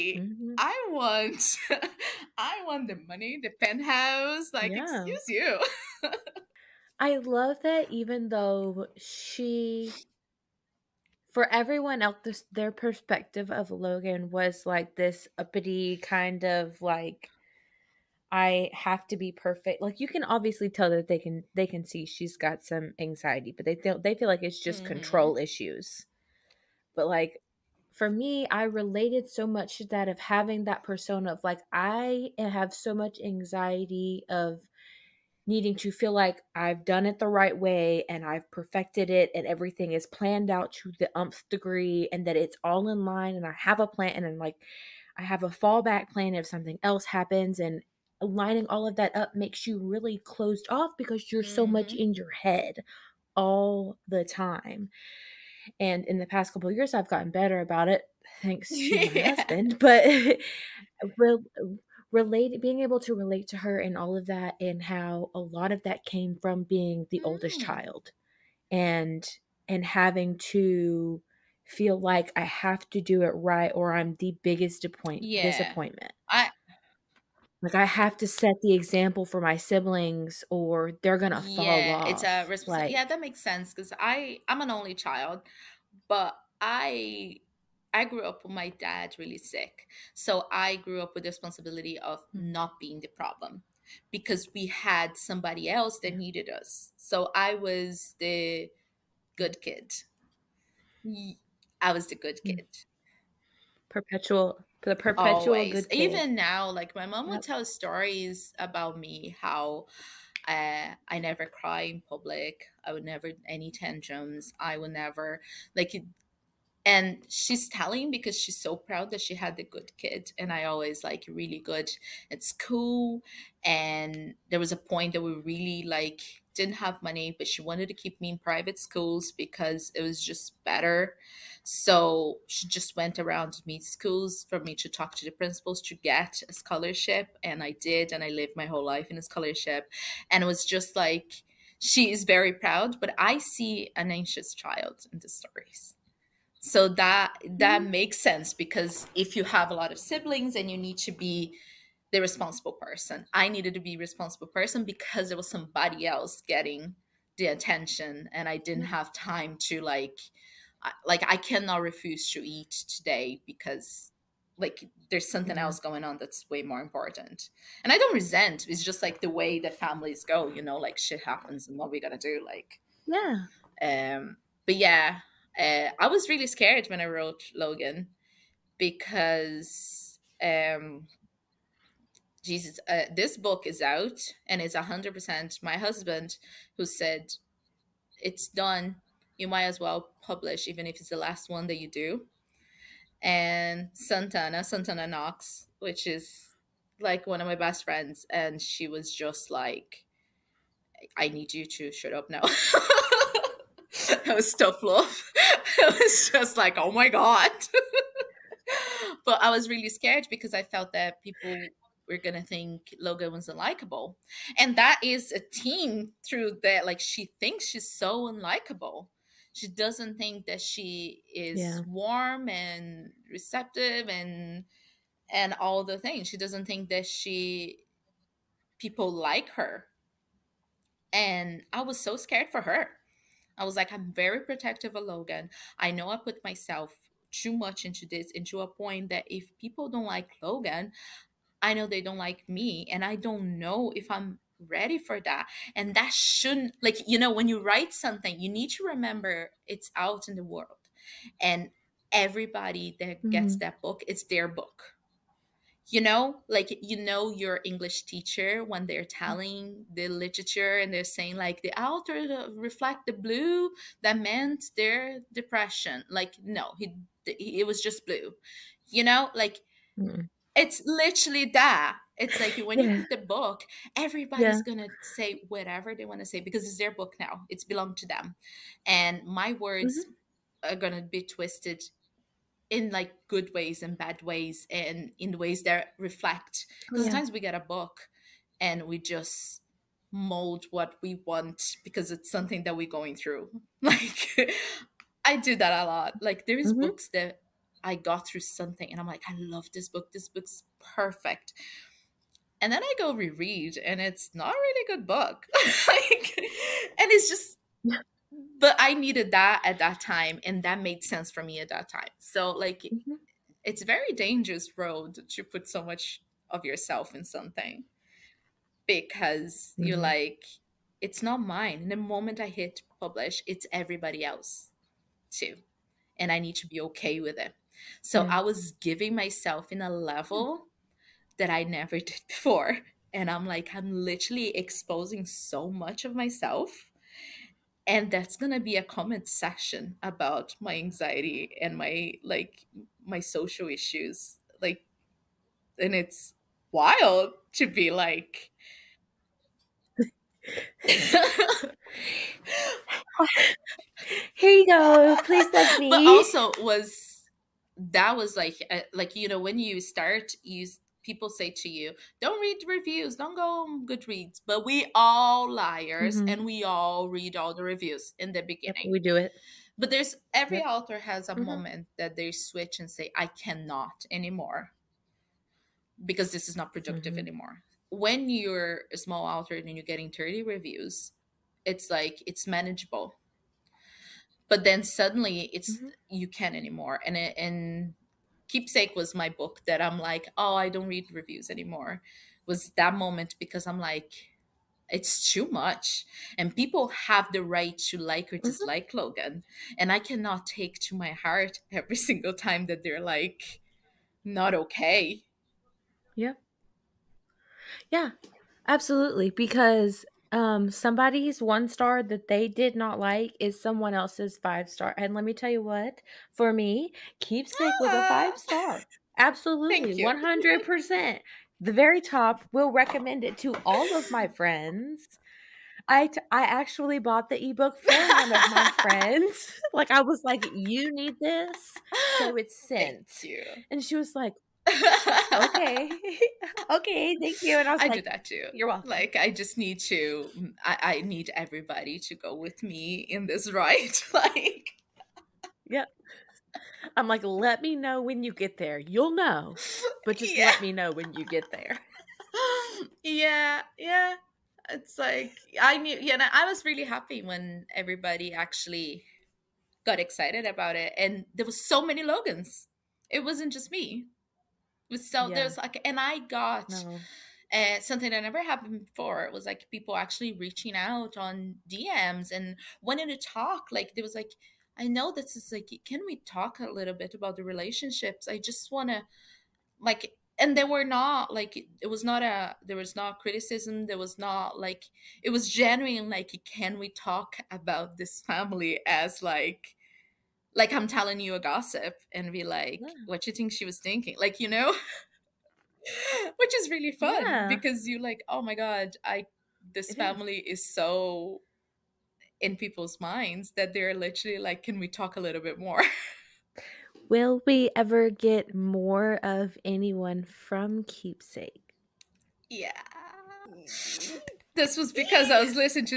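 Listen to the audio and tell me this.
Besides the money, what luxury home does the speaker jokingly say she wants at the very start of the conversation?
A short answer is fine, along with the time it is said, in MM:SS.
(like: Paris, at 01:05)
the penthouse, at 00:03.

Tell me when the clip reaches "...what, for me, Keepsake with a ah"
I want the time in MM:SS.
06:55.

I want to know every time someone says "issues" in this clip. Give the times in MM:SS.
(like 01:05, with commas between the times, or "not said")
00:25, 05:43.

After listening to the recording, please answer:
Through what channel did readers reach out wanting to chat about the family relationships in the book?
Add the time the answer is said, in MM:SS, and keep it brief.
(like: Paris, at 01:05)
DMs, at 07:51.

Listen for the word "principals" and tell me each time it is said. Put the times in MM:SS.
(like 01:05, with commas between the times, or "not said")
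02:15.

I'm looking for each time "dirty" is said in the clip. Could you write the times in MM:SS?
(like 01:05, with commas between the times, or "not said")
not said.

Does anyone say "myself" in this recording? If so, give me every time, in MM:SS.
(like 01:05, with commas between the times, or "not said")
03:56, 05:29, 05:36.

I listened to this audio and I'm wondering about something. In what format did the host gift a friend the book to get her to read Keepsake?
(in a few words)
ebook.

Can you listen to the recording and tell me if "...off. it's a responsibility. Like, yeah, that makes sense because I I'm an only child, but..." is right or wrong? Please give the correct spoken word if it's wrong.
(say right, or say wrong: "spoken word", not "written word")
right.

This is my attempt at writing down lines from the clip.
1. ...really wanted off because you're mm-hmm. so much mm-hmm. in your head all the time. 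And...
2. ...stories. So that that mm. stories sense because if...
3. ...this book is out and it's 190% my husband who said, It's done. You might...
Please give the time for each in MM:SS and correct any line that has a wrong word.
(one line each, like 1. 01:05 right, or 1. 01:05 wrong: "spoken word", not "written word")
1. 00:49 wrong: "closed", not "wanted"
2. 02:25 wrong: "makes", not "stories"
3. 03:03 wrong: "100", not "190".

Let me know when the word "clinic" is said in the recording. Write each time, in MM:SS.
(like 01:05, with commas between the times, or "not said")
not said.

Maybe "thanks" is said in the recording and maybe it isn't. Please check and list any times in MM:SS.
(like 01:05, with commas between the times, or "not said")
00:58, 07:17.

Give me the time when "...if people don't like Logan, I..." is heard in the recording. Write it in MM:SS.
03:59.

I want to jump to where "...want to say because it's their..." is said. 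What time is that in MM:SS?
04:36.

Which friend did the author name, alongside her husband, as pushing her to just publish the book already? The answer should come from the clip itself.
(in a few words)
Santana Knox.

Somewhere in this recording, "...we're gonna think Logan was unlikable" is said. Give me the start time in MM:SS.
03:32.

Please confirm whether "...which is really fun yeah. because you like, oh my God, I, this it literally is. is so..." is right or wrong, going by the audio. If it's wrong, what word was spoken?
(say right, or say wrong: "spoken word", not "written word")
wrong: "family", not "literally".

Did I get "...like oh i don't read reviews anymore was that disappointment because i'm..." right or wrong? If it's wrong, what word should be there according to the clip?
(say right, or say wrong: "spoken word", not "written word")
wrong: "moment", not "disappointment".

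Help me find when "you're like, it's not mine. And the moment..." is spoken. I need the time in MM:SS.
05:19.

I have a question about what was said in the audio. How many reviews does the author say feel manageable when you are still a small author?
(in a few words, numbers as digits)
30.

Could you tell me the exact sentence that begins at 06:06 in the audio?
and we all read all the reviews in the beginning yep, we do it but there's every yep.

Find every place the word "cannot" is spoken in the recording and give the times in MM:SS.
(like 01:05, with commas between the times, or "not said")
02:41, 06:13, 06:39.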